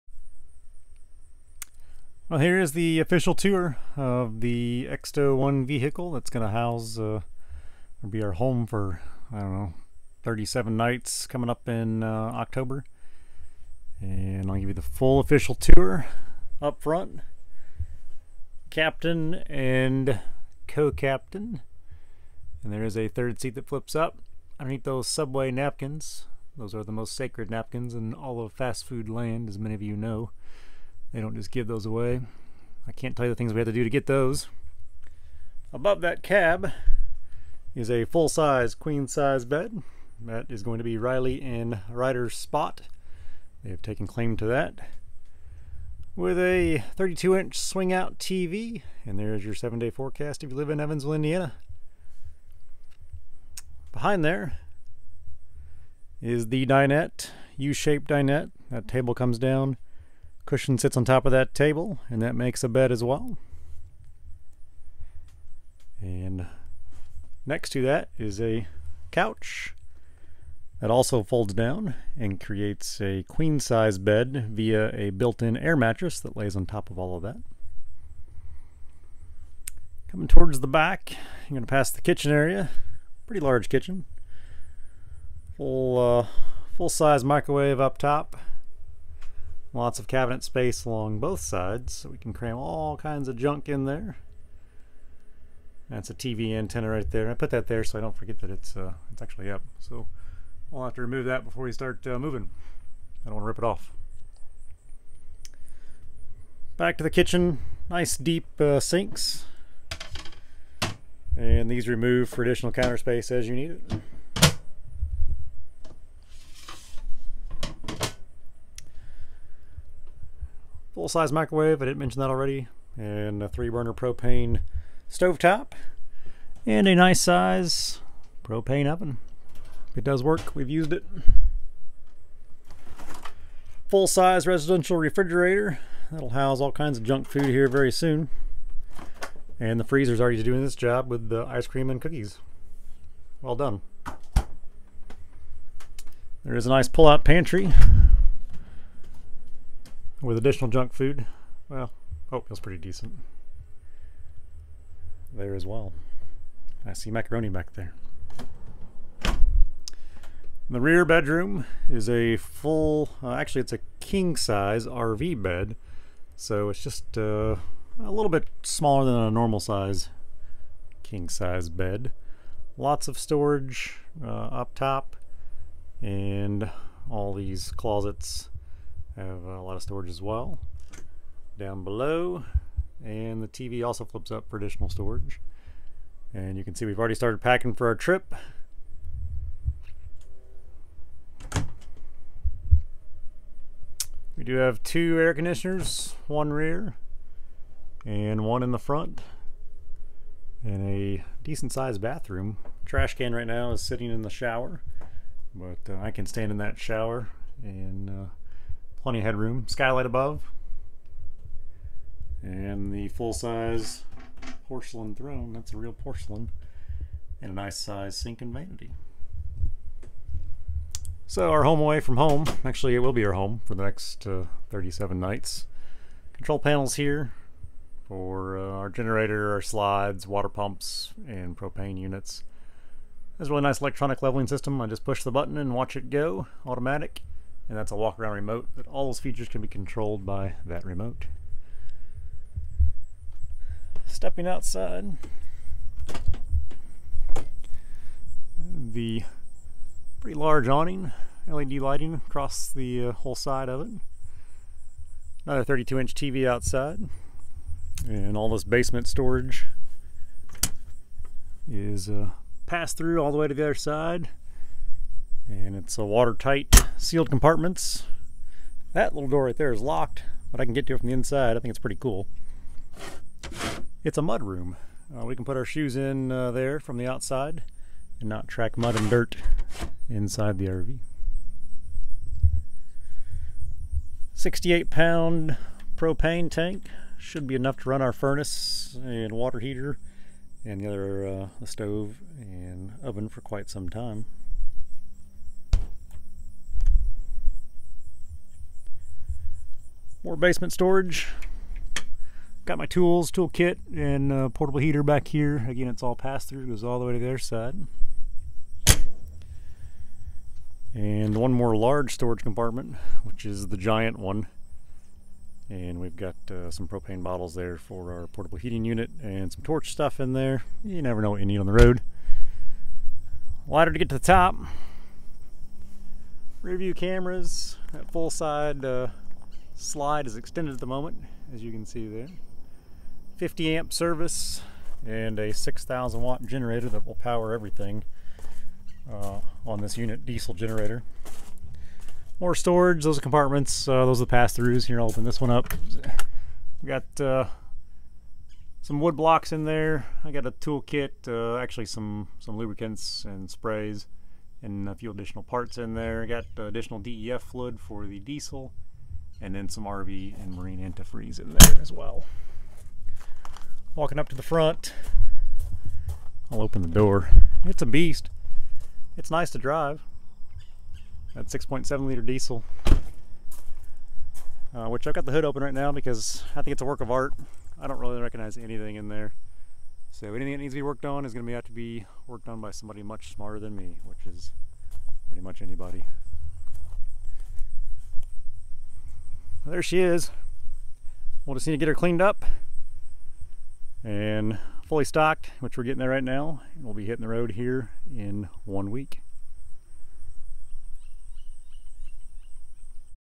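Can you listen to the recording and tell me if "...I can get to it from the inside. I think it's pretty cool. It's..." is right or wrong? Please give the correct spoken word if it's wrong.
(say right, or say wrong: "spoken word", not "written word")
right.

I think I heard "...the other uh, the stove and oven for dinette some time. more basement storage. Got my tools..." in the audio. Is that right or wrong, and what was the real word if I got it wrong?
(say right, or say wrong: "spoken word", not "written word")
wrong: "quite", not "dinette".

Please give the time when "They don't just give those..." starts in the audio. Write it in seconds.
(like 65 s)
31 s.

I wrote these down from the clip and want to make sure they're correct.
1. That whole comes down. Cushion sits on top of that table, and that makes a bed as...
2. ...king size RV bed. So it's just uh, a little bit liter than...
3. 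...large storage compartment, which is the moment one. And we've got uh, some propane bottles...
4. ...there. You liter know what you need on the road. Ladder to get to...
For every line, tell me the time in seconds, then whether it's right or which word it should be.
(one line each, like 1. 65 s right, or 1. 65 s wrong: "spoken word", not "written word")
1. 58 s wrong: "table", not "whole"
2. 163 s wrong: "smaller", not "liter"
3. 311 s wrong: "giant", not "moment"
4. 320 s wrong: "never", not "liter".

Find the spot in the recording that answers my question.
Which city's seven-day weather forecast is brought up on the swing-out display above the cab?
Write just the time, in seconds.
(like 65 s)
50 s.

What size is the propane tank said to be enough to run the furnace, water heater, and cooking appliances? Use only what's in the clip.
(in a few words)
68 pound.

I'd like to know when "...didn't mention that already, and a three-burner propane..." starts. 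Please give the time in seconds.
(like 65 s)
121 s.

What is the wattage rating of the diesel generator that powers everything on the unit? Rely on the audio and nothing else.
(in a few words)
6,000 watts.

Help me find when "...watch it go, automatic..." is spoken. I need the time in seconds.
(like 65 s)
235 s.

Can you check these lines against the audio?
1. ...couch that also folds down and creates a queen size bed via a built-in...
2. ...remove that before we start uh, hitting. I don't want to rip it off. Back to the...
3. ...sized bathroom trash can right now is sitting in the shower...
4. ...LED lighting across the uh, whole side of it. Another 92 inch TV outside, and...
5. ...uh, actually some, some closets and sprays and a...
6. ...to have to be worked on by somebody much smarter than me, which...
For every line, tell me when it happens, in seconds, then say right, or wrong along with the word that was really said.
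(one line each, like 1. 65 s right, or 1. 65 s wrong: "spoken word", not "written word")
1. 69 s right
2. 101 s wrong: "moving", not "hitting"
3. 201 s right
4. 251 s wrong: "32", not "92"
5. 351 s wrong: "lubricants", not "closets"
6. 381 s right.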